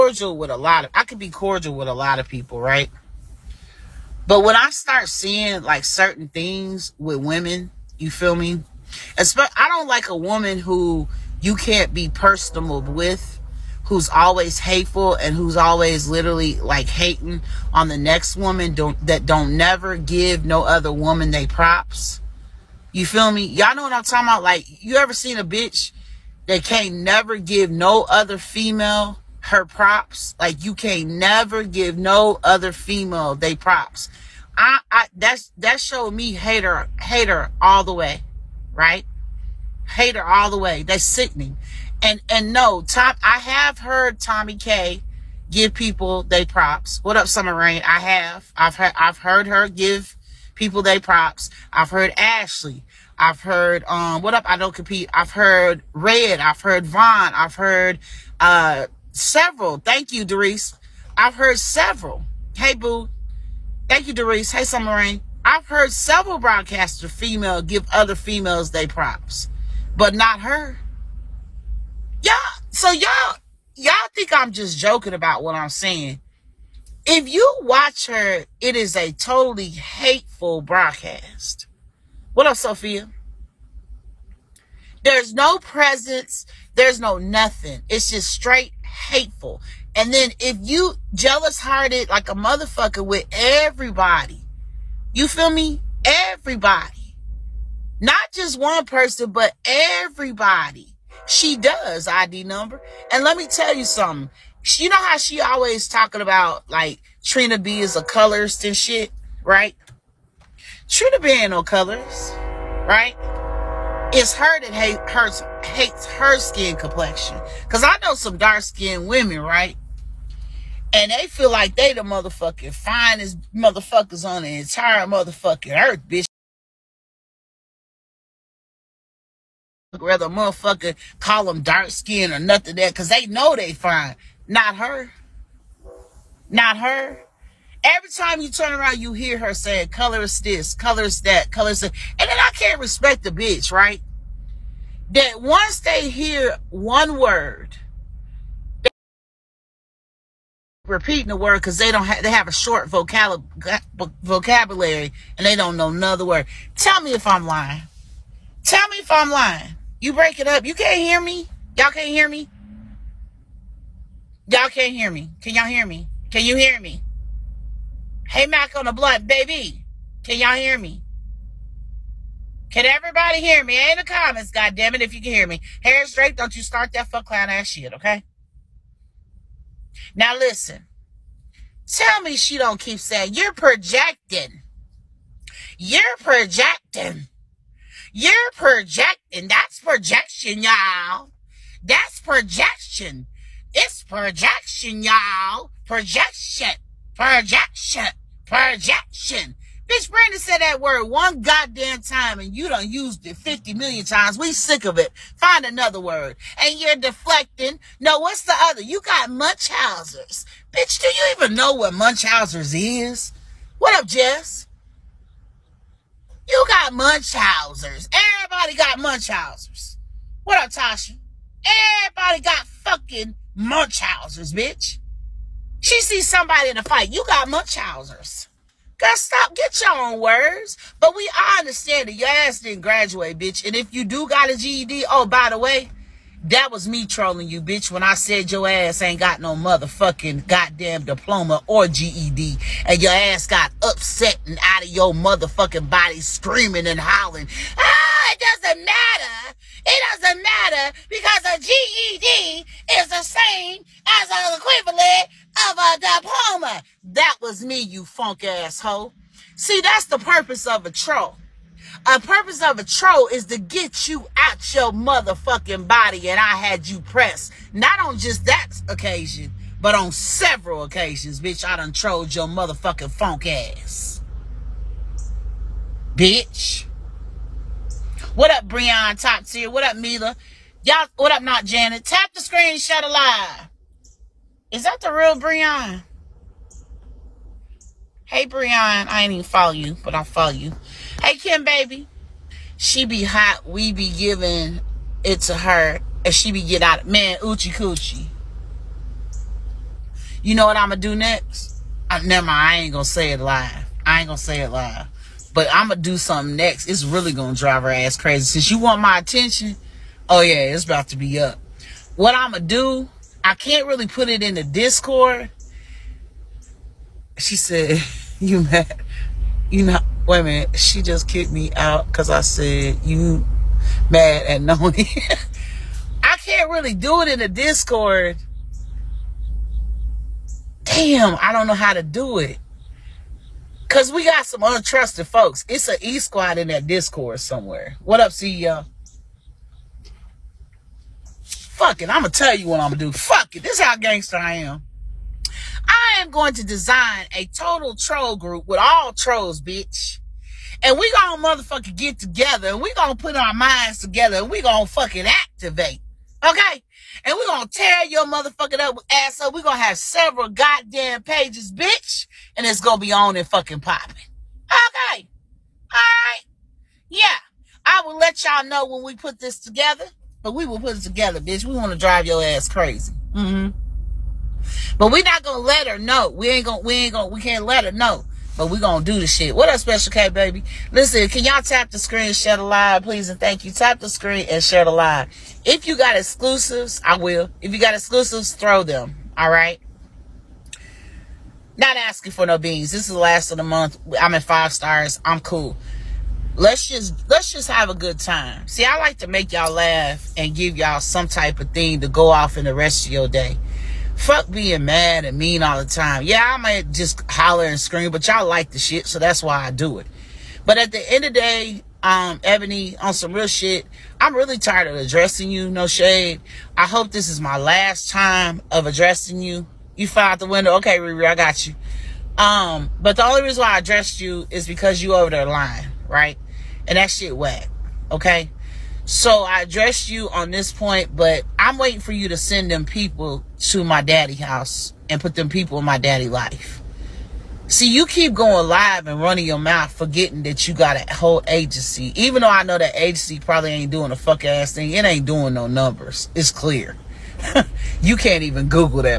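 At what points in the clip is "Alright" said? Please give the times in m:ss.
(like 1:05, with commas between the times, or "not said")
6:05.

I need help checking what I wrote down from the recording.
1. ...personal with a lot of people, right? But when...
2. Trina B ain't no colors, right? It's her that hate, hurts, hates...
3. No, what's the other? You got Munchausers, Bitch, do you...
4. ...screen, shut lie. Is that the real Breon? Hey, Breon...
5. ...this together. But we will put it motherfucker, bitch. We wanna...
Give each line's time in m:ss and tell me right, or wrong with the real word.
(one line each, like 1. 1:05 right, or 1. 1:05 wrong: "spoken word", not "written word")
1. 0:01 wrong: "cordial", not "personal"
2. 1:50 right
3. 3:27 right
4. 4:42 right
5. 6:09 wrong: "together", not "motherfucker".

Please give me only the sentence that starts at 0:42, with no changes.
And and no, Tom, I have heard Tommy K give people they props.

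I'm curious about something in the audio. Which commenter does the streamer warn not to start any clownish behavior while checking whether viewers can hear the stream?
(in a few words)
Harris Drake.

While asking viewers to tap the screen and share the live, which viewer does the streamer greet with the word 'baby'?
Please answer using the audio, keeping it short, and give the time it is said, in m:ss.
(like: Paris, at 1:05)
Special K, at 6:19.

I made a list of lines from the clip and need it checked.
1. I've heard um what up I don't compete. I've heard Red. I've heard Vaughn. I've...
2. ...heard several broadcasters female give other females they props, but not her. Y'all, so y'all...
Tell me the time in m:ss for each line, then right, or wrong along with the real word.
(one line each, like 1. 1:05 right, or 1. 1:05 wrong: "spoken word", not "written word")
1. 0:53 right
2. 1:05 right.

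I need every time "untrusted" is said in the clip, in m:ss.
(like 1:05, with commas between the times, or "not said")
5:34.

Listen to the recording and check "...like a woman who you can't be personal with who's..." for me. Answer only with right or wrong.
right.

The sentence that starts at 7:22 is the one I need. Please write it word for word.
Even though I know that agency probably ain't doing a fuck ass thing, it ain't doing no numbers.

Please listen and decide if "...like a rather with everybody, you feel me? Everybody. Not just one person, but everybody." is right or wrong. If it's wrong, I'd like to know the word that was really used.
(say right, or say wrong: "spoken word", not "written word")
wrong: "motherfucker", not "rather".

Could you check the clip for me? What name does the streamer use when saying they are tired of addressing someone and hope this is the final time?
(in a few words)
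Ebony.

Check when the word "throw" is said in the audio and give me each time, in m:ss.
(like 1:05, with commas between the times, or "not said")
6:28.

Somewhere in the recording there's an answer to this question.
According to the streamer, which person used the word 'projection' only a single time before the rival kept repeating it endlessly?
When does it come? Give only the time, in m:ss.
3:20.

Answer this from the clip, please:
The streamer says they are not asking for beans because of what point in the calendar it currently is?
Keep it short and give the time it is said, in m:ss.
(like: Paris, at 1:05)
The last of the month, at 6:33.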